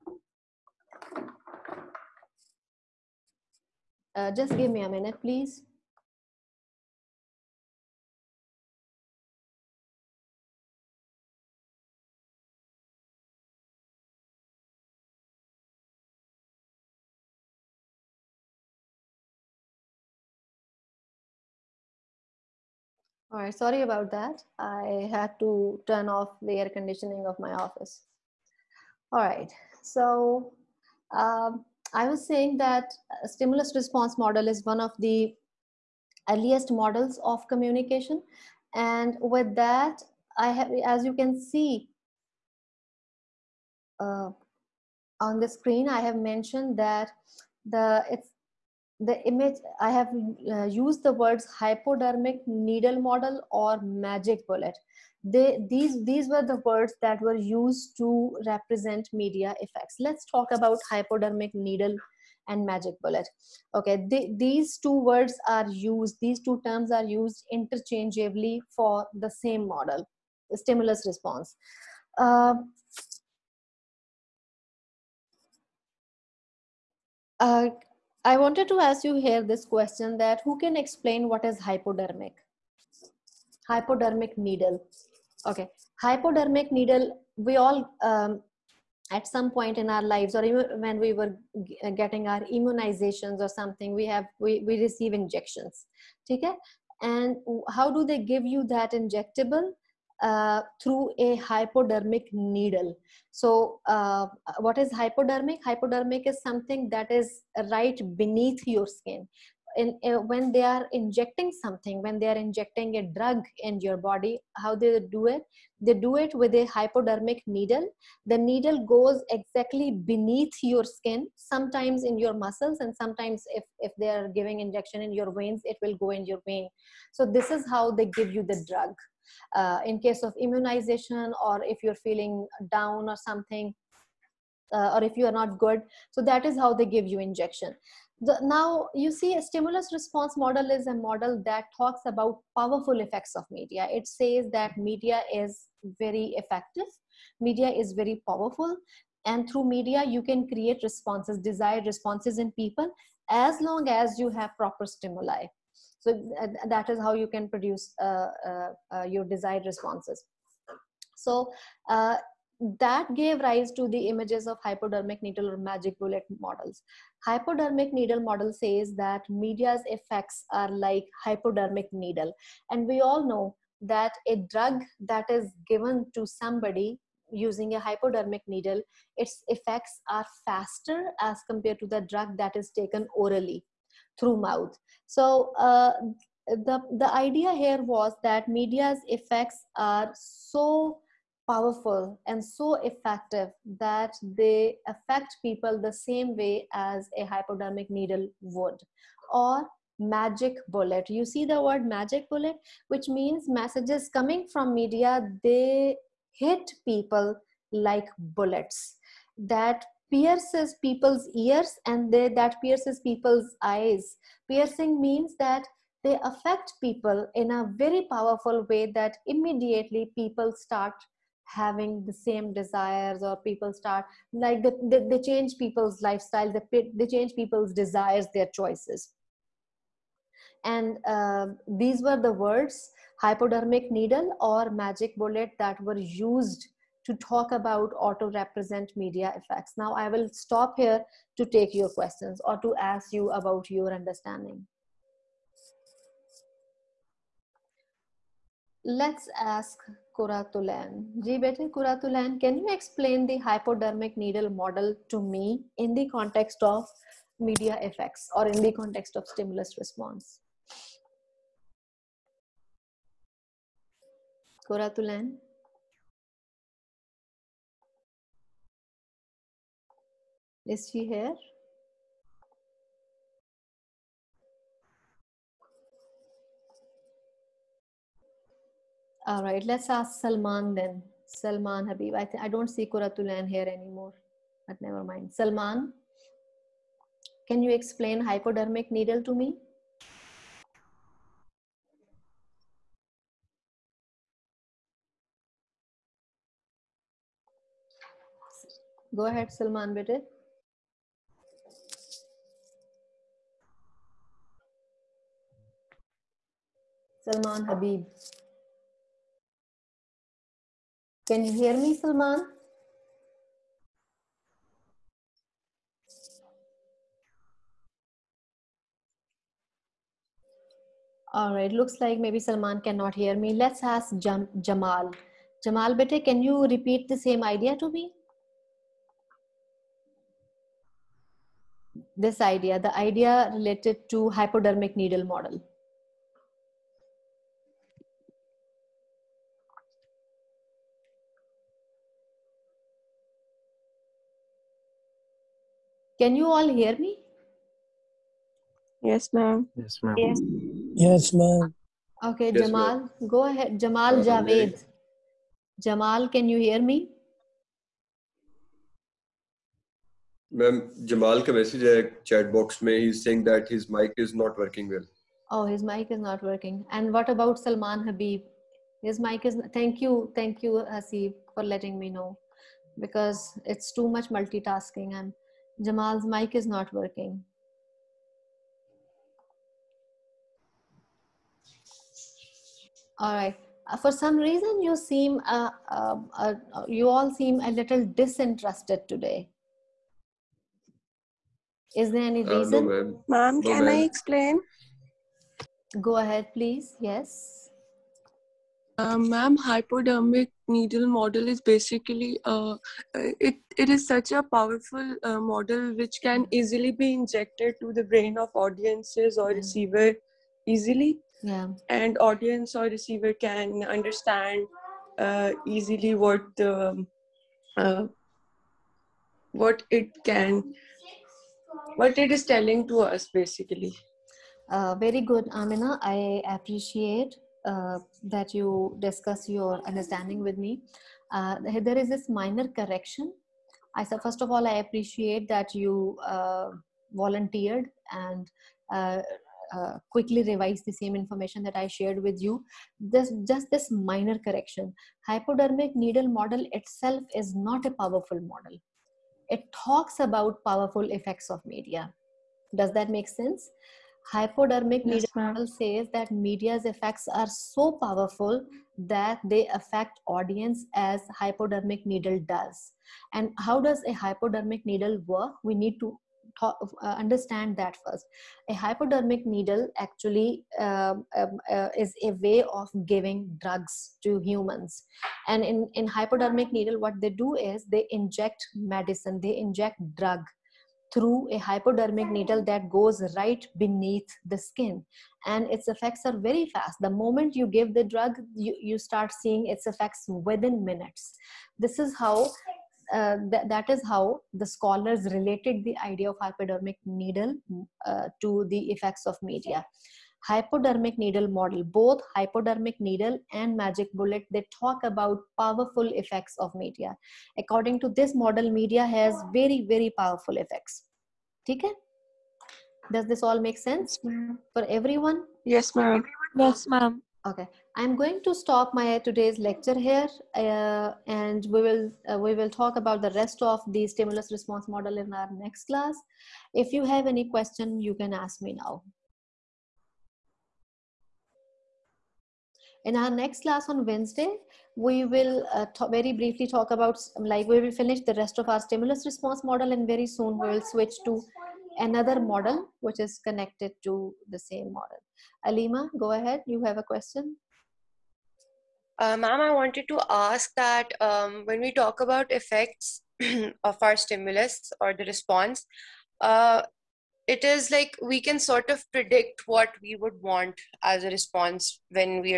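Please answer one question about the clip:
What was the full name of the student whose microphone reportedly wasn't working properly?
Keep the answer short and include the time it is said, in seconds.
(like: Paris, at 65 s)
Jamal Javed, at 353 s.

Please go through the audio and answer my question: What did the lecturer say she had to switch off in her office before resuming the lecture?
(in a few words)
air conditioning.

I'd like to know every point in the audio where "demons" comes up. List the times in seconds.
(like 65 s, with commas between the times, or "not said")
not said.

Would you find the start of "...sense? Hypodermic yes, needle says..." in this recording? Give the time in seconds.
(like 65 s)
453 s.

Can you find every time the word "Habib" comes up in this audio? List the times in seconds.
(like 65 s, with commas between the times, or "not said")
281 s, 307 s, 368 s.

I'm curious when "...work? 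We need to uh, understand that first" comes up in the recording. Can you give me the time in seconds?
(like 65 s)
465 s.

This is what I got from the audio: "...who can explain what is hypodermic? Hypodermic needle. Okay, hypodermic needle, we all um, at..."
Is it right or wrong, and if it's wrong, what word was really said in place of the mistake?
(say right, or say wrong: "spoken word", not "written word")
right.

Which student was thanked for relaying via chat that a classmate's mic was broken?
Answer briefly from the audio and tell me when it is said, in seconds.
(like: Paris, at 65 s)
Hasib, at 370 s.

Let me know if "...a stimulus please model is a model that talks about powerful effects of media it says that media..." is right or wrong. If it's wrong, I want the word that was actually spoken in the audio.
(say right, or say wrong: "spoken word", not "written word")
wrong: "response", not "please".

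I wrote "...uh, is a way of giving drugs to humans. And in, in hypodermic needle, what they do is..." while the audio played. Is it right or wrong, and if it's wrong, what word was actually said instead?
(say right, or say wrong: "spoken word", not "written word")
right.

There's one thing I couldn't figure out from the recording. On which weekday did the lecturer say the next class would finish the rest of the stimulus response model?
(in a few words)
Wednesday.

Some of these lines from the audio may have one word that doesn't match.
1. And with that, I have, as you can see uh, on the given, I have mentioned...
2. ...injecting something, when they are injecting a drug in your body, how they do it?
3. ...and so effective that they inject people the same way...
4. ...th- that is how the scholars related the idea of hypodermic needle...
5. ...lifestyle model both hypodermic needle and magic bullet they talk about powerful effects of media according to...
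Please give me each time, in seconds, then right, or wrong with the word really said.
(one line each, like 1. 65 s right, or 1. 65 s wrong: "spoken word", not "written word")
1. 38 s wrong: "screen", not "given"
2. 110 s right
3. 192 s wrong: "affect", not "inject"
4. 493 s right
5. 501 s wrong: "needle", not "lifestyle".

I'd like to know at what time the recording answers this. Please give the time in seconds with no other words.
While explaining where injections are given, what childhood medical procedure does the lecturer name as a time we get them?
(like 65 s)
92 s.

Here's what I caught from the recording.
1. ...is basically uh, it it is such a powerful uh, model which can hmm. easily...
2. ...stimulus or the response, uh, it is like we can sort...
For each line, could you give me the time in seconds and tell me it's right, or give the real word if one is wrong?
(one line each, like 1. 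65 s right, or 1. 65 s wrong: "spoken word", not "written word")
1. 401 s right
2. 554 s right.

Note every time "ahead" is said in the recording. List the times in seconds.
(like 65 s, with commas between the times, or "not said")
299 s, 353 s, 396 s, 546 s.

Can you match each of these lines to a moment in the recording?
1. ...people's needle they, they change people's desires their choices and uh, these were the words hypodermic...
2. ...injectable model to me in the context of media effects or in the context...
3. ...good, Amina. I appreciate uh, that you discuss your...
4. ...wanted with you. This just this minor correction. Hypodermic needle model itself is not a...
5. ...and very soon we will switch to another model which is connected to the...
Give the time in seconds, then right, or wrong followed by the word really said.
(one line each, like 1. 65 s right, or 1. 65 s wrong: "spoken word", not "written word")
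1. 225 s wrong: "lifestyle", not "needle"
2. 254 s wrong: "needle", not "injectable"
3. 425 s right
4. 441 s wrong: "shared", not "wanted"
5. 539 s right.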